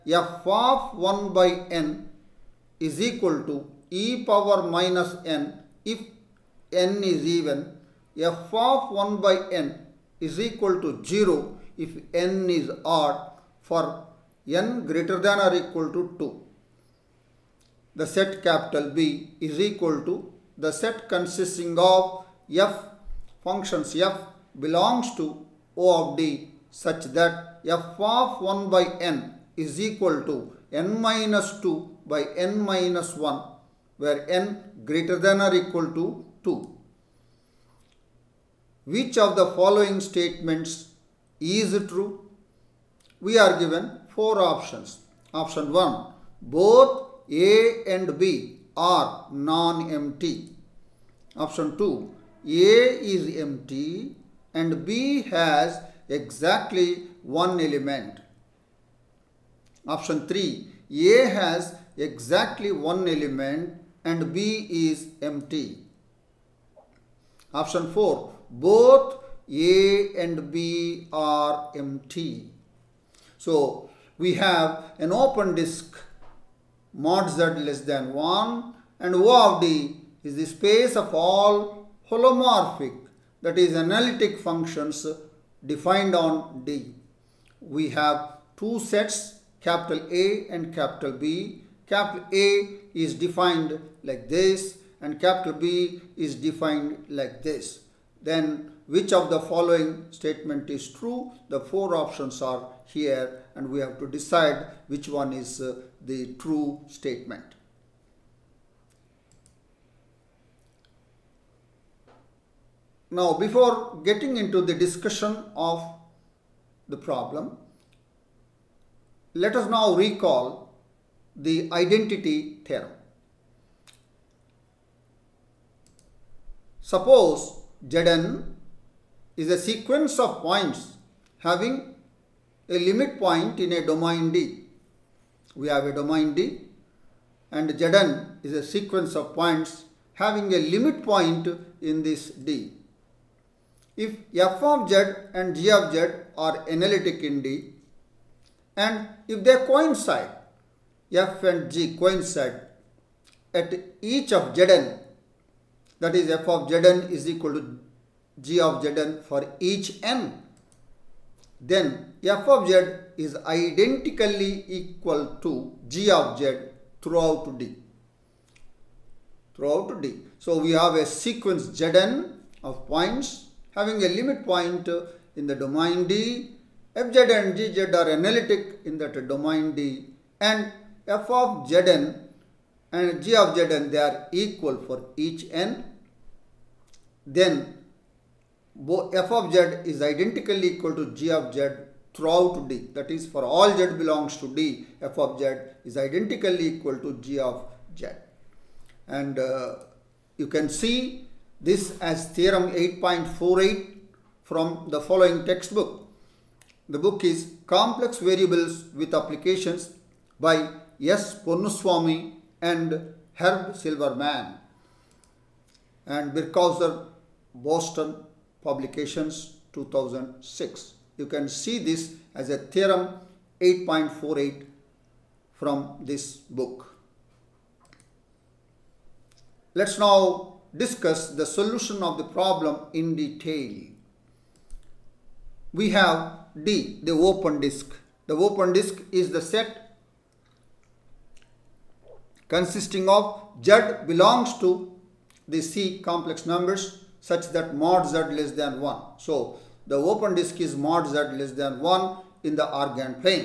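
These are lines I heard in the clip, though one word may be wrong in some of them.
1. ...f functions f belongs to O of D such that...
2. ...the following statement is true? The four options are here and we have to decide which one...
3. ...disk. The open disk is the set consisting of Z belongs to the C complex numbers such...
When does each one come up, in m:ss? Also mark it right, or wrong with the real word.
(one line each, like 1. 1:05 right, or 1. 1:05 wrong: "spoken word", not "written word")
1. 0:22 right
2. 1:39 right
3. 3:57 right.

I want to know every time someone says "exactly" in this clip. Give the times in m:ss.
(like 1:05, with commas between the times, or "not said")
0:56, 1:01.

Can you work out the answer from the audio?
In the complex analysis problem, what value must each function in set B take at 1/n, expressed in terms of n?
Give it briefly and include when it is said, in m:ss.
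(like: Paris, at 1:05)
(n-2)/(n-1), at 0:30.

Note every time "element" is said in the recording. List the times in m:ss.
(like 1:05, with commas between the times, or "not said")
0:57, 1:03.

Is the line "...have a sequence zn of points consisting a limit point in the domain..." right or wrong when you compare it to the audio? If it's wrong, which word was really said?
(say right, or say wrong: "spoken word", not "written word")
wrong: "having", not "consisting".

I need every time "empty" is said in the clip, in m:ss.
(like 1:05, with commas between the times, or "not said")
0:49, 0:53, 1:05, 1:11.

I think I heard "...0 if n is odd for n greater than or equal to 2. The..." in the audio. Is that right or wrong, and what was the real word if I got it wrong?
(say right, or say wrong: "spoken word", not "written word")
right.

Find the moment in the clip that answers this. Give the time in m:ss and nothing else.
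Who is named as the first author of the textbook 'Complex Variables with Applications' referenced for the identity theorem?
3:31.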